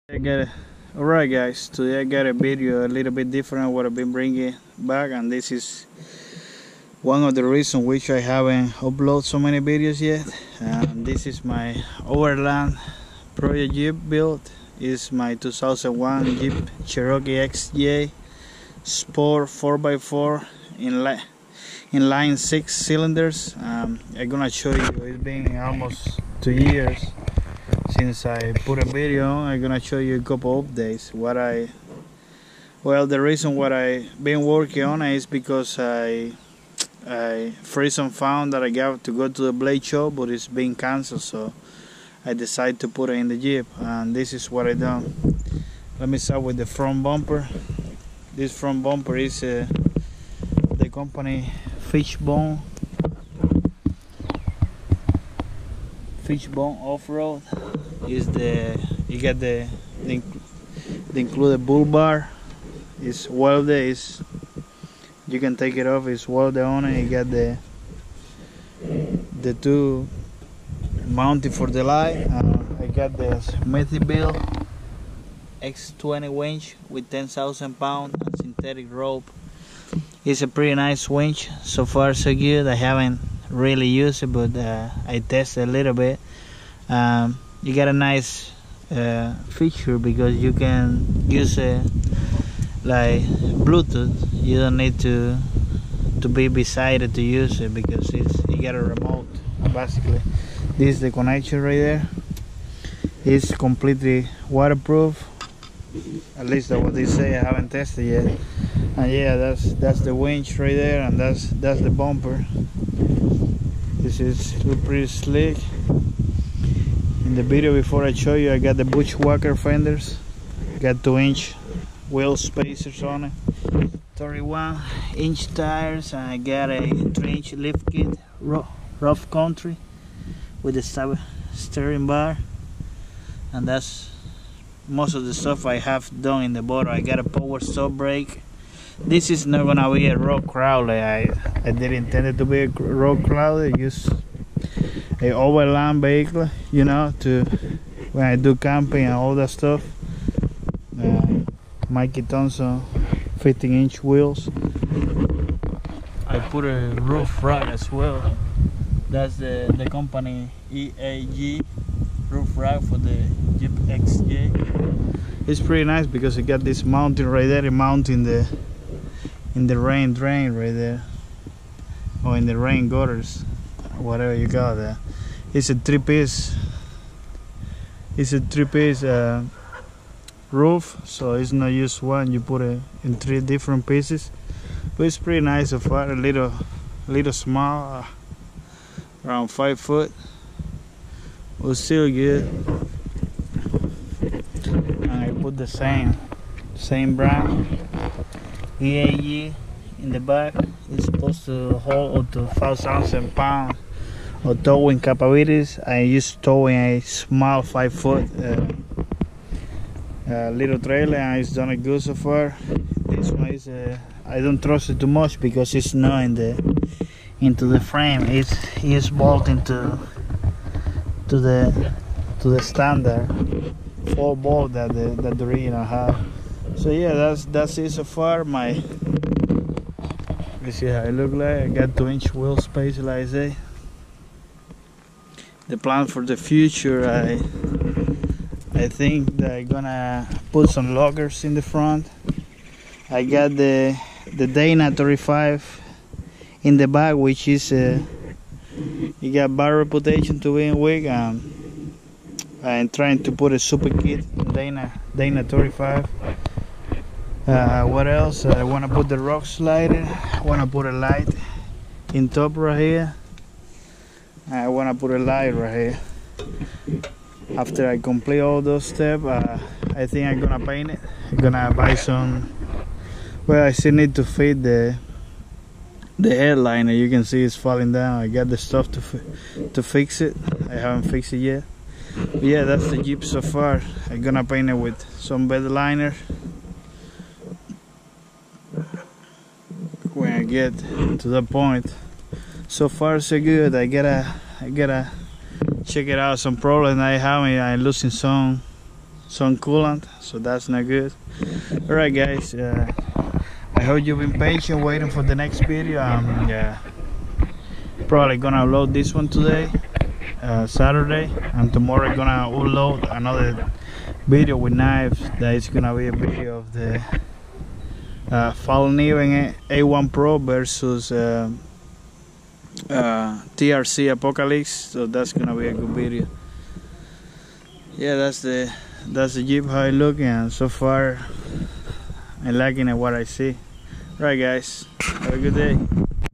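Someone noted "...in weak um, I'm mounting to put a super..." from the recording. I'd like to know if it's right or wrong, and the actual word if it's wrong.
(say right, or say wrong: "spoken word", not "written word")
wrong: "trying", not "mounting".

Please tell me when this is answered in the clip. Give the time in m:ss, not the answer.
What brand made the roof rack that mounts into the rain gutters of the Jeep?
2:40.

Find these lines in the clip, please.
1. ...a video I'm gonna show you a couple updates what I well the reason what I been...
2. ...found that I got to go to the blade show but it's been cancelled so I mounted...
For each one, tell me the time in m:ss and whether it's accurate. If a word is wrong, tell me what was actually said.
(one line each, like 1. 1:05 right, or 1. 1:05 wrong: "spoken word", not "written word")
1. 0:28 right
2. 0:38 wrong: "decided", not "mounted".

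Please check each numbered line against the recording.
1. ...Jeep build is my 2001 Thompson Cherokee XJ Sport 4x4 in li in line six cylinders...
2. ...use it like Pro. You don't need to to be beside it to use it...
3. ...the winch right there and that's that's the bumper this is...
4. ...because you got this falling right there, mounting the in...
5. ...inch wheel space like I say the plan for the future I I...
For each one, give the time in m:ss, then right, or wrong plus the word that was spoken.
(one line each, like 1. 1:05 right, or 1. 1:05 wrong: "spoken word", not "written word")
1. 0:13 wrong: "Jeep", not "Thompson"
2. 1:31 wrong: "Bluetooth", not "Pro"
3. 1:50 right
4. 2:46 wrong: "mounting", not "falling"
5. 3:52 right.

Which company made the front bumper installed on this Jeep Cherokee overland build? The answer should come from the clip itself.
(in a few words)
Fishbone Off-Road.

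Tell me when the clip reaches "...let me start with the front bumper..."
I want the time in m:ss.
0:45.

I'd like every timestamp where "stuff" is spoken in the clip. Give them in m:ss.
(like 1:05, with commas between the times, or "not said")
2:15, 2:29, 4:38.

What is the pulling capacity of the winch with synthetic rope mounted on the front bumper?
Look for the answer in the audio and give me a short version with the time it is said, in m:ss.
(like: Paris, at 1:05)
10,000 pounds, at 1:17.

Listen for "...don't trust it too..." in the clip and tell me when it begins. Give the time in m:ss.
3:34.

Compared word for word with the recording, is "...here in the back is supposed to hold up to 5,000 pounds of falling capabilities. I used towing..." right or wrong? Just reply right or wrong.
wrong.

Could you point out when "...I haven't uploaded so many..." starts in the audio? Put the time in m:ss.
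0:08.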